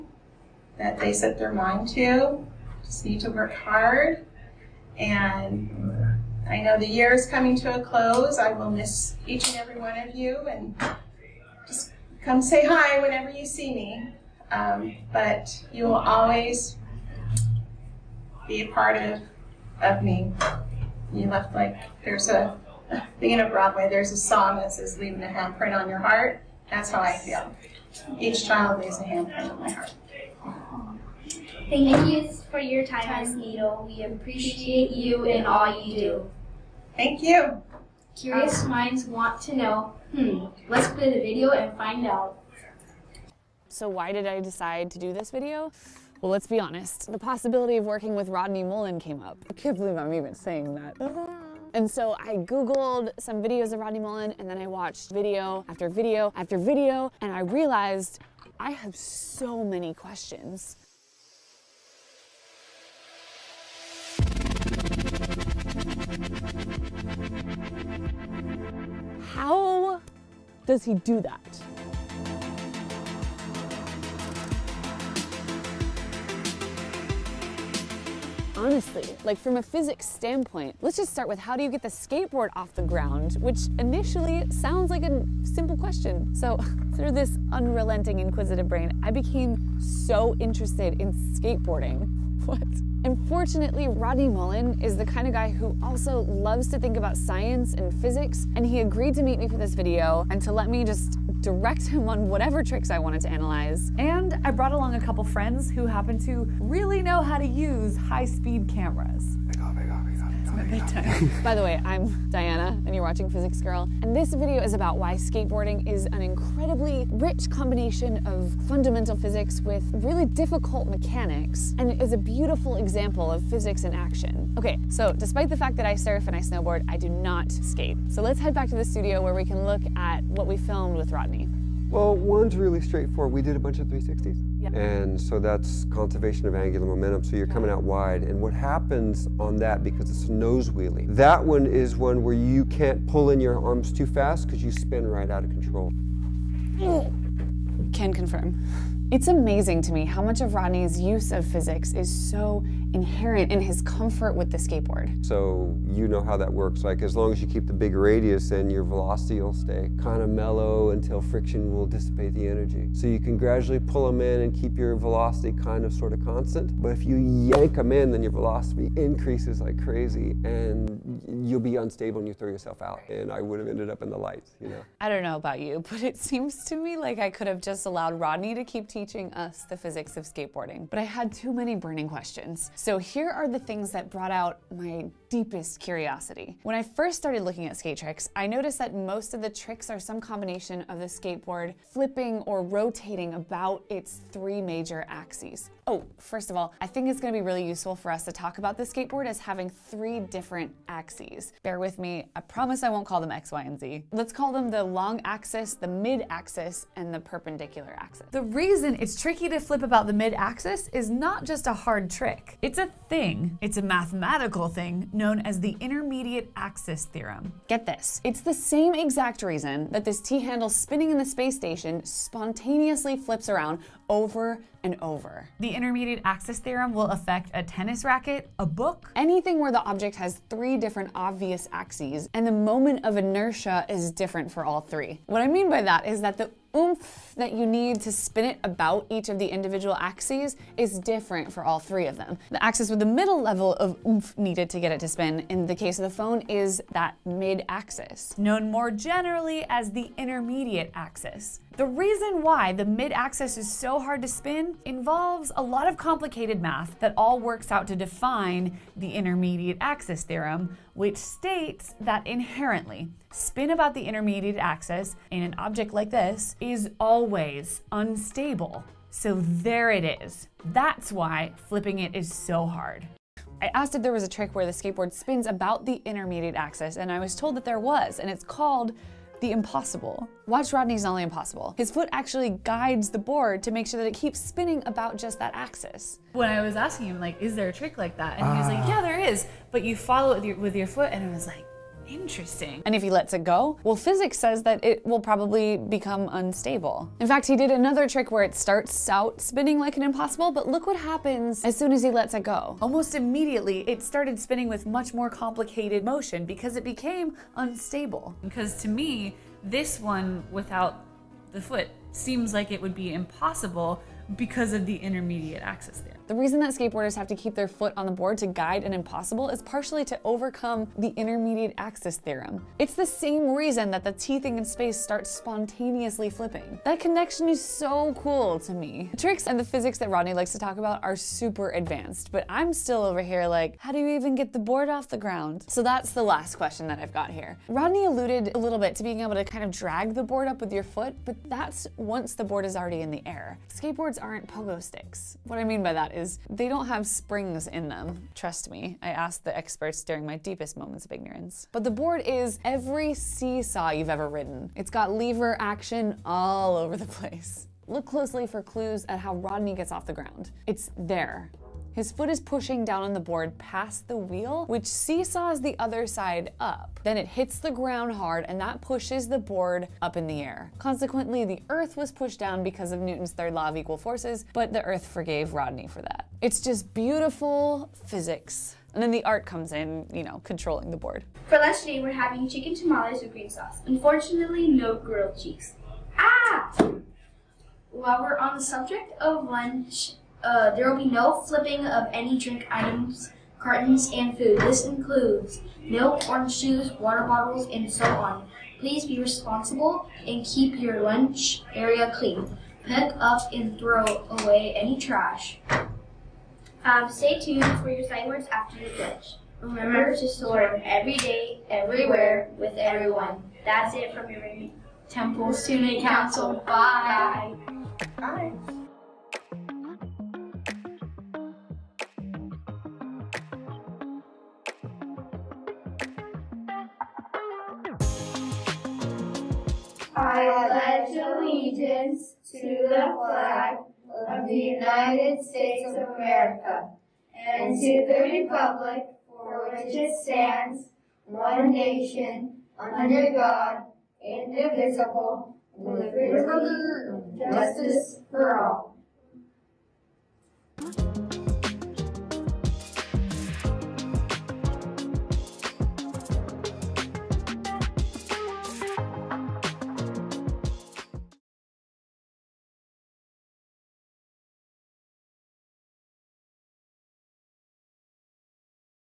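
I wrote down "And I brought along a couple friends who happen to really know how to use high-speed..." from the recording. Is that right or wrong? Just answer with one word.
right.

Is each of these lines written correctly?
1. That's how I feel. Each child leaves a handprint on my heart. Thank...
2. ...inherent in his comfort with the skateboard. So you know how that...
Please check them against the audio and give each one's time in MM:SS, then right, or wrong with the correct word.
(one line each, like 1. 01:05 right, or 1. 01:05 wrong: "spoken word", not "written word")
1. 00:26 right
2. 02:32 right.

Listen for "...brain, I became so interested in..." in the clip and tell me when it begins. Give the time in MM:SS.
01:28.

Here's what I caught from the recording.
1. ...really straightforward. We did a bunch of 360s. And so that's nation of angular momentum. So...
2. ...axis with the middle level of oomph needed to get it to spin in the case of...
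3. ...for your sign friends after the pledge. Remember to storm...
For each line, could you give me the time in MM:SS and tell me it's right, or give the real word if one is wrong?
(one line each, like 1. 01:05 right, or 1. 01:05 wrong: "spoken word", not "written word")
1. 02:12 wrong: "conservation", not "nation"
2. 04:02 right
3. 06:47 wrong: "words", not "friends".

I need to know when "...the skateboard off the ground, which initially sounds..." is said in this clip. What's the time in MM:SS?
01:21.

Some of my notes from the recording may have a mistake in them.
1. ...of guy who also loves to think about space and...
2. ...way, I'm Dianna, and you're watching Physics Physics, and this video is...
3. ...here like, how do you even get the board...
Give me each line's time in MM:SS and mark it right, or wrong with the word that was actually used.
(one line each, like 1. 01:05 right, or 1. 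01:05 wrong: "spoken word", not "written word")
1. 01:35 wrong: "science", not "space"
2. 01:51 wrong: "Girl", not "Physics"
3. 05:33 right.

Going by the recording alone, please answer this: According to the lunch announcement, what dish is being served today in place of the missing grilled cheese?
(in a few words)
chicken tamales with green sauce.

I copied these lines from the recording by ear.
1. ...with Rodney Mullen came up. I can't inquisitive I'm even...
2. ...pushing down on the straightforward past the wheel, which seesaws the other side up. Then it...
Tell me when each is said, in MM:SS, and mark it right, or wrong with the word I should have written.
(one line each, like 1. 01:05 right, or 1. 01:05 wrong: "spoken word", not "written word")
1. 00:48 wrong: "believe", not "inquisitive"
2. 06:02 wrong: "board", not "straightforward".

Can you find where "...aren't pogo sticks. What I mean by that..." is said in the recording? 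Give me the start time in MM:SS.
05:44.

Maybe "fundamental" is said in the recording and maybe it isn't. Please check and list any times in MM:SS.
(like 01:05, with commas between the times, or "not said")
01:58.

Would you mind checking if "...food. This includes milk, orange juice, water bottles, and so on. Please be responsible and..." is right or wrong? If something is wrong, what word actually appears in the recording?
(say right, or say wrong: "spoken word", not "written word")
right.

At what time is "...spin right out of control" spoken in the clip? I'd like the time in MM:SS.
02:24.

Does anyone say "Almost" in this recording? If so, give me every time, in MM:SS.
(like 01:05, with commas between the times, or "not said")
05:02.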